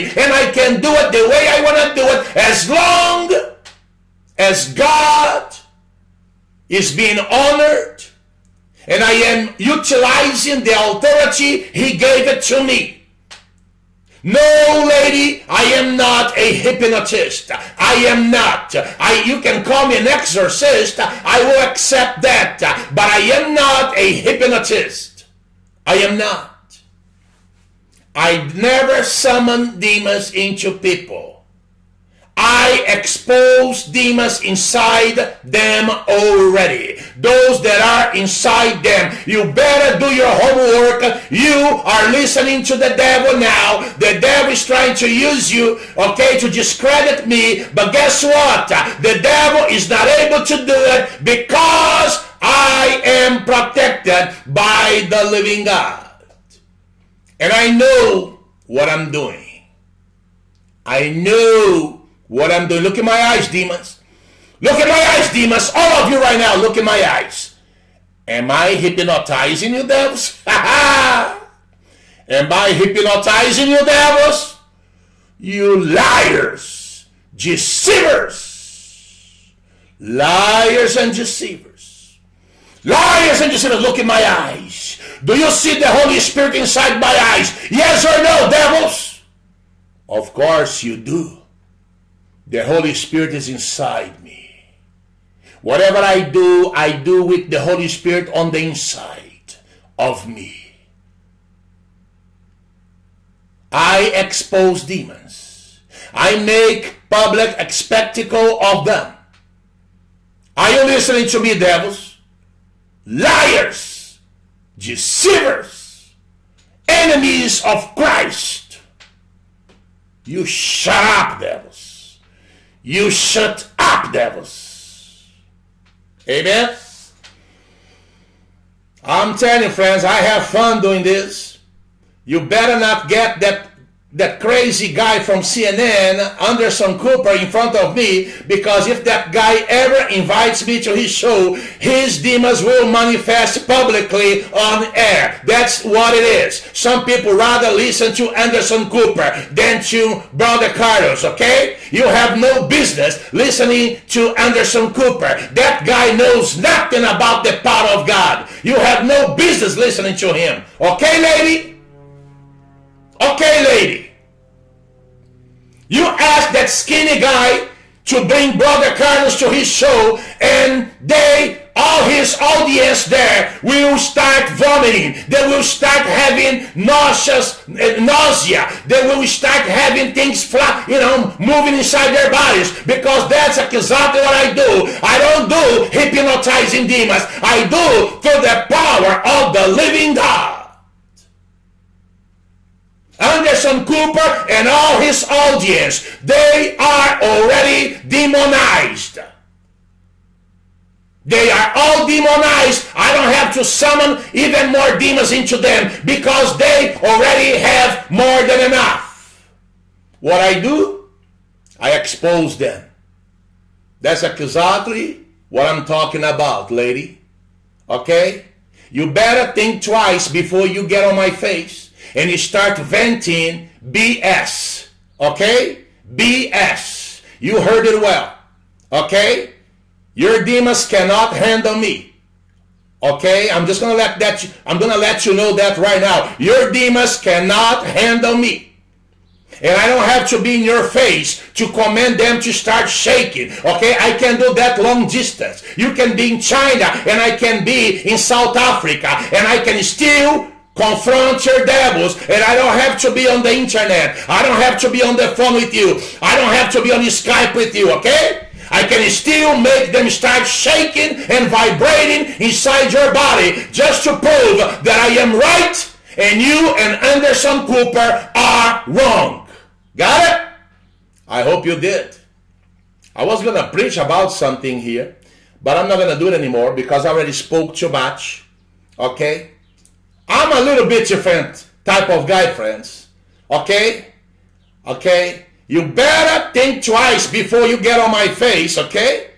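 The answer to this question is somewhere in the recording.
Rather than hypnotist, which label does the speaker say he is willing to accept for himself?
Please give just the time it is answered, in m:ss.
0:20.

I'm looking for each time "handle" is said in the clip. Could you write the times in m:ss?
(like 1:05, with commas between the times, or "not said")
3:51, 3:57.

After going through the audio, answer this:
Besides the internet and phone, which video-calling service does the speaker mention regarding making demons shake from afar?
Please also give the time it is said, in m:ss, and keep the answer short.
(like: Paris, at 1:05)
Skype, at 4:17.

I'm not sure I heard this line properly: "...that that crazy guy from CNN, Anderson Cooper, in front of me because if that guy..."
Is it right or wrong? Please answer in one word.
right.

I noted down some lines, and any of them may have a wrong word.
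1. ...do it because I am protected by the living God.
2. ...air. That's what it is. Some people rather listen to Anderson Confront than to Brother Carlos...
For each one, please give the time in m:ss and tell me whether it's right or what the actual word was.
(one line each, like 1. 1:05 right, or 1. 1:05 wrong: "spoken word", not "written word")
1. 0:50 right
2. 2:24 wrong: "Cooper", not "Confront".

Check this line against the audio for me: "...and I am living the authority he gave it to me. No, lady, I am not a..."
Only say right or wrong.
wrong.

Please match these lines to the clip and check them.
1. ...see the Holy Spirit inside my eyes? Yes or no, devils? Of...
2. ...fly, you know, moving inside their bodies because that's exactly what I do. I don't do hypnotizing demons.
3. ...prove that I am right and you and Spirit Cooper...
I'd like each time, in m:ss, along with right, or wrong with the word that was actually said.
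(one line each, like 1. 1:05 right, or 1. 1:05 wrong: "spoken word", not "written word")
1. 1:25 right
2. 3:00 right
3. 4:24 wrong: "Anderson", not "Spirit".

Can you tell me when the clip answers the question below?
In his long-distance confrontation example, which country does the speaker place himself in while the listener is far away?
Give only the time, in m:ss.
4:08.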